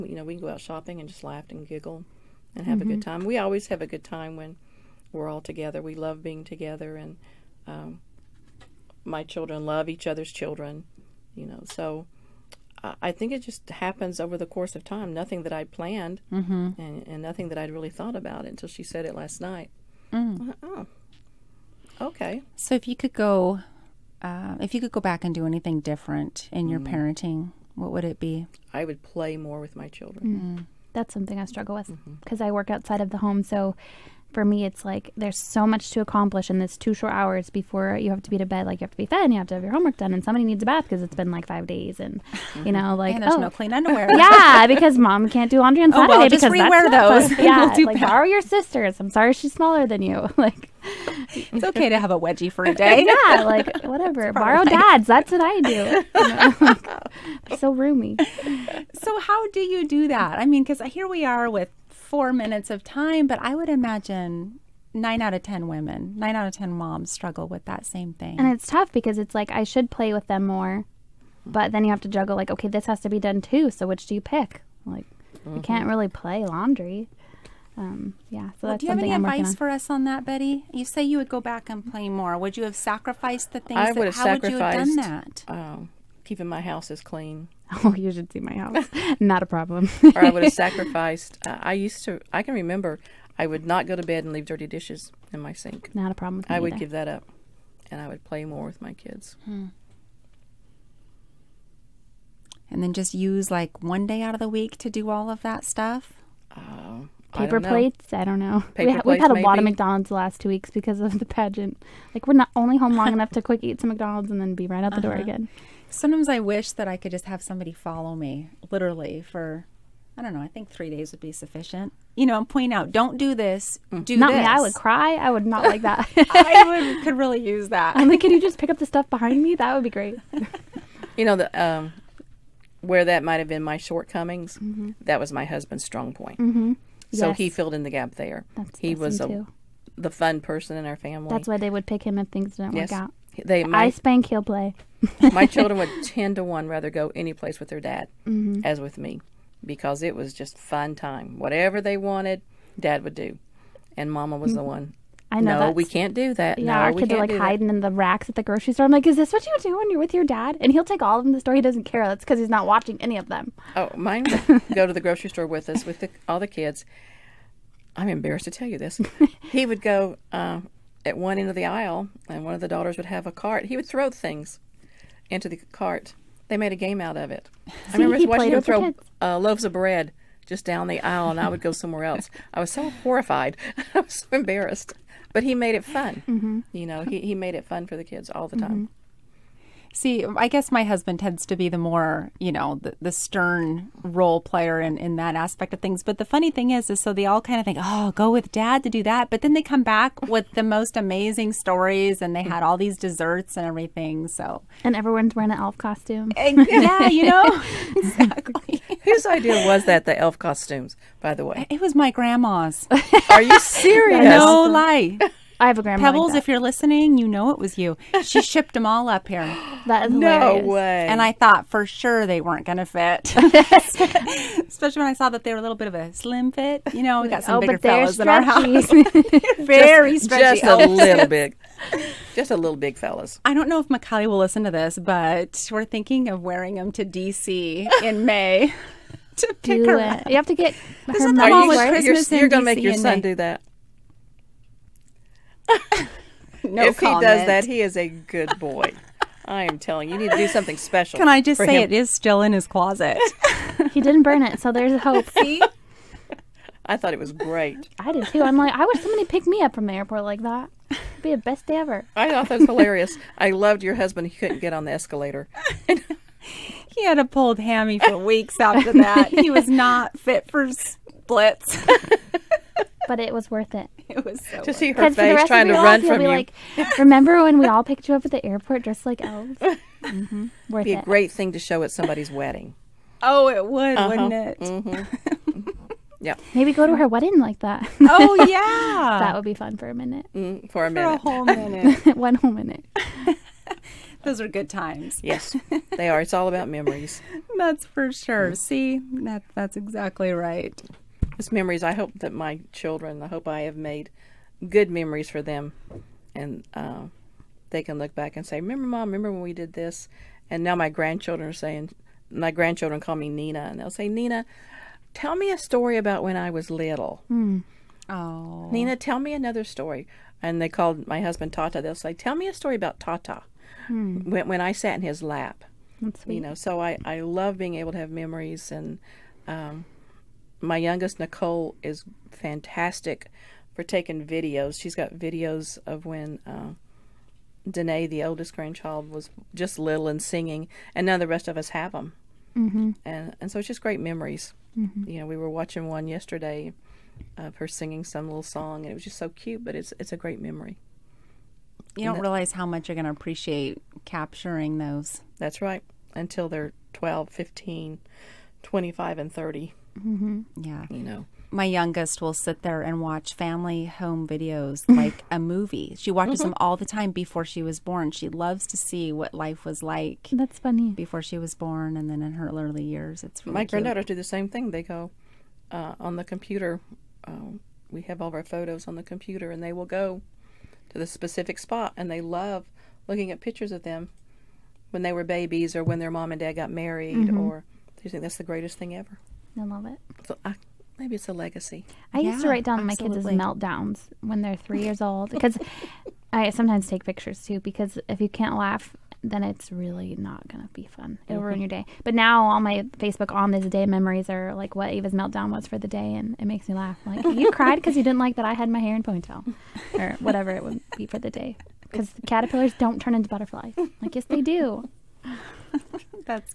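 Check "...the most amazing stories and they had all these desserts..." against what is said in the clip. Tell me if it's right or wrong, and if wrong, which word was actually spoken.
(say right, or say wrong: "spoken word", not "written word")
right.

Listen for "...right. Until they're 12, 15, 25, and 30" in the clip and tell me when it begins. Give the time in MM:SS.
05:55.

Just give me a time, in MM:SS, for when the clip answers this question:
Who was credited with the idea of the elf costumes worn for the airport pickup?
03:36.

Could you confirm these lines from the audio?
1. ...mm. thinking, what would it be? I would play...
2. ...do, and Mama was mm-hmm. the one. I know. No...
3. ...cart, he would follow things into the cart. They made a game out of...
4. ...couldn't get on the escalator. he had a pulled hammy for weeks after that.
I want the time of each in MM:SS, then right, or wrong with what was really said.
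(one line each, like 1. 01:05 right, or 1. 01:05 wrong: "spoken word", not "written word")
1. 00:26 wrong: "parenting", not "thinking"
2. 02:33 right
3. 02:53 wrong: "throw", not "follow"
4. 04:24 right.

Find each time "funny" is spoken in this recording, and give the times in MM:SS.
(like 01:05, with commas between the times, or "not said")
03:16, 06:10.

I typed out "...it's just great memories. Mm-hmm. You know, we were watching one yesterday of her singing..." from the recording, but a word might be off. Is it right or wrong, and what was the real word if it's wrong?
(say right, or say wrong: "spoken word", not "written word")
right.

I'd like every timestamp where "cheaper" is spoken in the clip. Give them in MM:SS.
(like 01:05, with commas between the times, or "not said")
not said.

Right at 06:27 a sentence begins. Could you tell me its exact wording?
or think that's the greatest thing ever.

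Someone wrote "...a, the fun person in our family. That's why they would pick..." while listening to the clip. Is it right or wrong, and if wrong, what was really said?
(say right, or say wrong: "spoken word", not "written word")
right.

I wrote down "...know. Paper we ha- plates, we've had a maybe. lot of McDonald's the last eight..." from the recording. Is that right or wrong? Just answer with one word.
wrong.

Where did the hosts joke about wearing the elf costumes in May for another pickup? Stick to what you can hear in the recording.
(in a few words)
DC.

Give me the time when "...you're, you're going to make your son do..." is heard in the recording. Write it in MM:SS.
04:02.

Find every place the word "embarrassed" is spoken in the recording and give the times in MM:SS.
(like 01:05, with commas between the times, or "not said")
02:48, 03:04.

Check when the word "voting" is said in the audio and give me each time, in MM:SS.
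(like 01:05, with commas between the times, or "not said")
not said.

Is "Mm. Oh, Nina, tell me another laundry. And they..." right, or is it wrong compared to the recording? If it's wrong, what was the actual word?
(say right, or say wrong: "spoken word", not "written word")
wrong: "story", not "laundry".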